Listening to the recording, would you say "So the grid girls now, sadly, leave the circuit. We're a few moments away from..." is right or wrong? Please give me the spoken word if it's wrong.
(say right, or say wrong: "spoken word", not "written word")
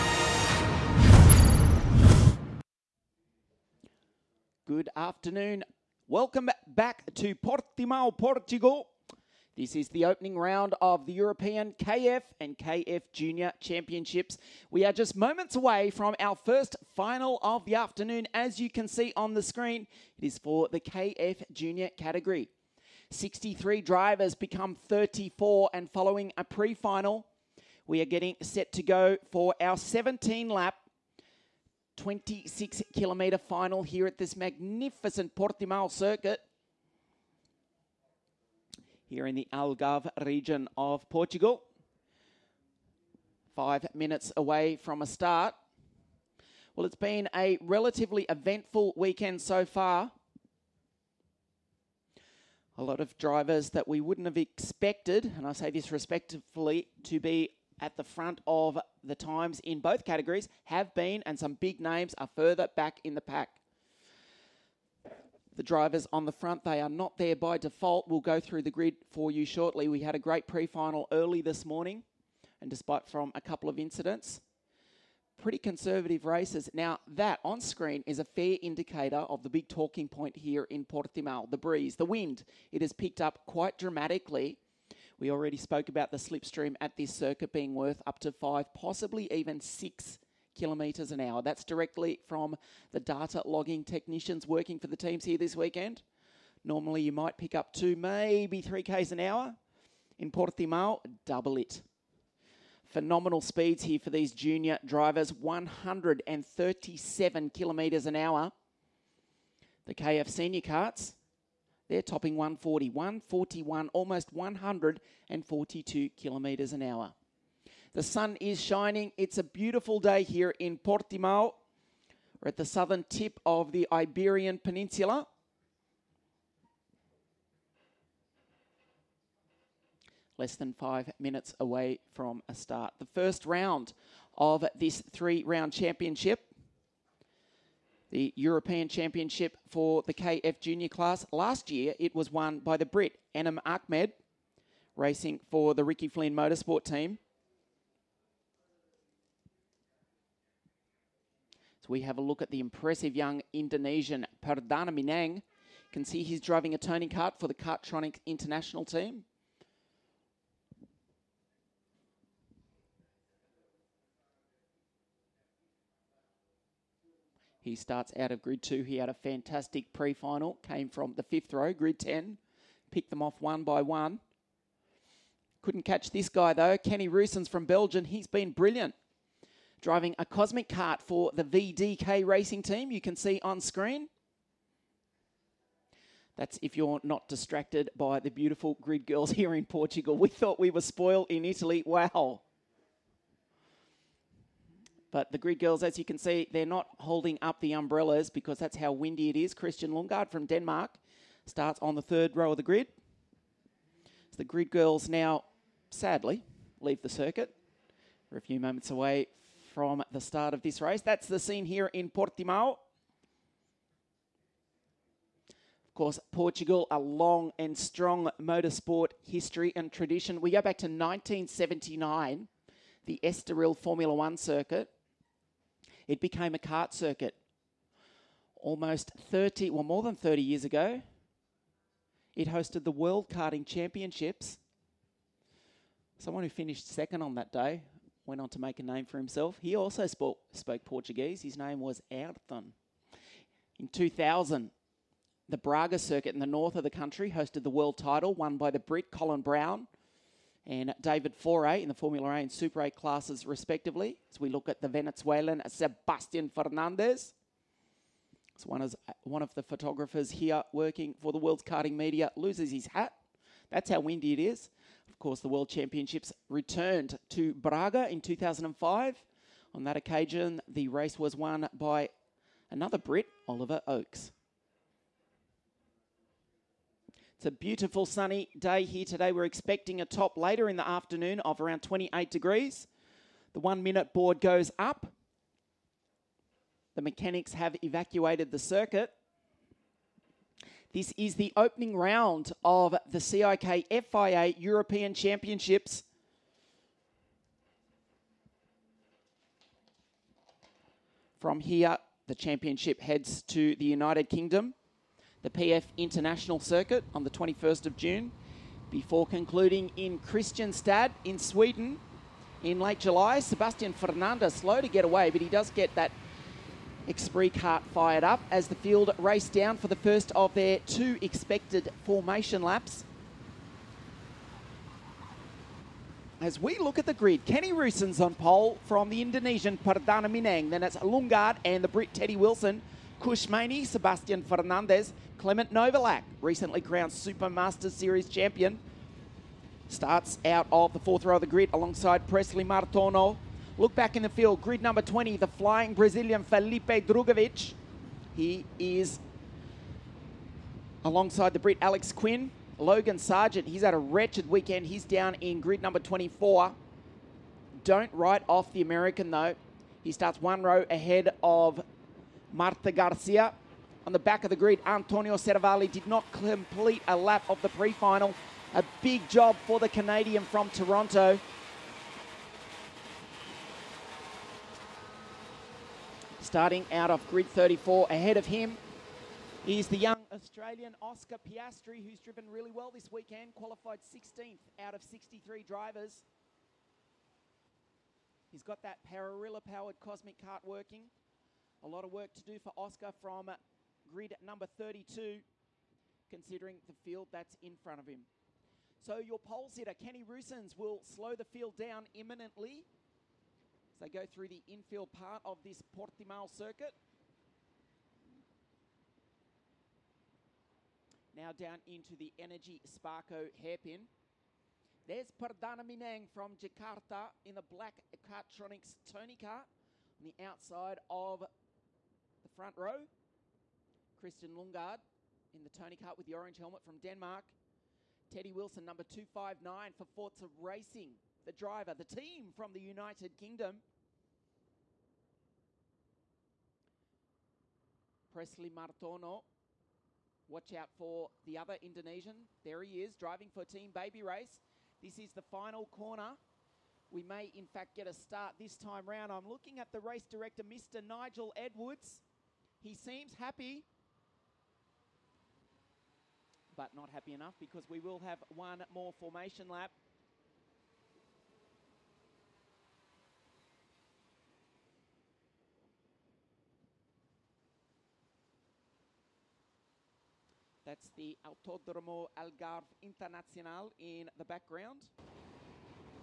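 right.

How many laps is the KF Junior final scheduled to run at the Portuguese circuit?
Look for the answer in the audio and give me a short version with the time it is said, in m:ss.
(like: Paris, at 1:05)
17, at 0:29.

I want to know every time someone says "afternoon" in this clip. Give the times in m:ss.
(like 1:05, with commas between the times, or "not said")
0:05, 0:17, 4:40.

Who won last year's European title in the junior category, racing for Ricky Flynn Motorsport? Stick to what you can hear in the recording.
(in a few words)
Enaam Ahmed.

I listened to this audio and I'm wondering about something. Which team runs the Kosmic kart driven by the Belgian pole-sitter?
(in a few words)
VDK racing.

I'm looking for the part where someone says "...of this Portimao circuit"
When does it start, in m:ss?
6:45.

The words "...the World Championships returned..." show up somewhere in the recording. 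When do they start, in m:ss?
4:25.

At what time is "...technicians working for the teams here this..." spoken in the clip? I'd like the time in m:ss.
1:33.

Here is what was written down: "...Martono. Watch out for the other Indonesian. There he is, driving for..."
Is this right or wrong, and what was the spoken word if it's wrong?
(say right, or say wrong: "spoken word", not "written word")
right.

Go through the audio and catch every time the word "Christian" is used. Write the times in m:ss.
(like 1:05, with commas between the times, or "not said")
3:19, 7:04.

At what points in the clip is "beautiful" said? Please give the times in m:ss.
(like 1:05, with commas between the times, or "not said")
1:59, 3:08, 4:37.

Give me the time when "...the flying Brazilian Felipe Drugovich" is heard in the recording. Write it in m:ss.
5:45.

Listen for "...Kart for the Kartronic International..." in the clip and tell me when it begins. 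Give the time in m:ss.
2:37.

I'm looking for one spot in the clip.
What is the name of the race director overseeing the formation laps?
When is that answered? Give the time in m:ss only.
7:31.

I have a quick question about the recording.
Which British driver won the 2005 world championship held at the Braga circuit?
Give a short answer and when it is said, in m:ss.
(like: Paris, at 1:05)
Oliver Oakes, at 4:33.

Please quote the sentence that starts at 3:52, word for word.
It hosted the World Karting Championships.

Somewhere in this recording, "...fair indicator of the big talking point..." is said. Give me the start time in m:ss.
1:18.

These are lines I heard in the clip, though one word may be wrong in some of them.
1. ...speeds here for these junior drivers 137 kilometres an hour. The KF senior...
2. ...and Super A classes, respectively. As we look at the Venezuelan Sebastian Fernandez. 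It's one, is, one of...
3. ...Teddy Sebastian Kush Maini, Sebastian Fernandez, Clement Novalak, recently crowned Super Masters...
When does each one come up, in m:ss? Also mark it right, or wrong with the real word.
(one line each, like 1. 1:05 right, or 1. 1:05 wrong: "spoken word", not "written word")
1. 1:43 right
2. 4:12 right
3. 5:32 wrong: "Wilson", not "Sebastian".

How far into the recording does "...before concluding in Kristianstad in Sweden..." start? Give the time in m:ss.
5:08.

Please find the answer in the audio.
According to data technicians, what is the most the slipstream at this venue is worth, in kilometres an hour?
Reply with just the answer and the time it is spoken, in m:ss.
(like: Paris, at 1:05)
6, at 1:29.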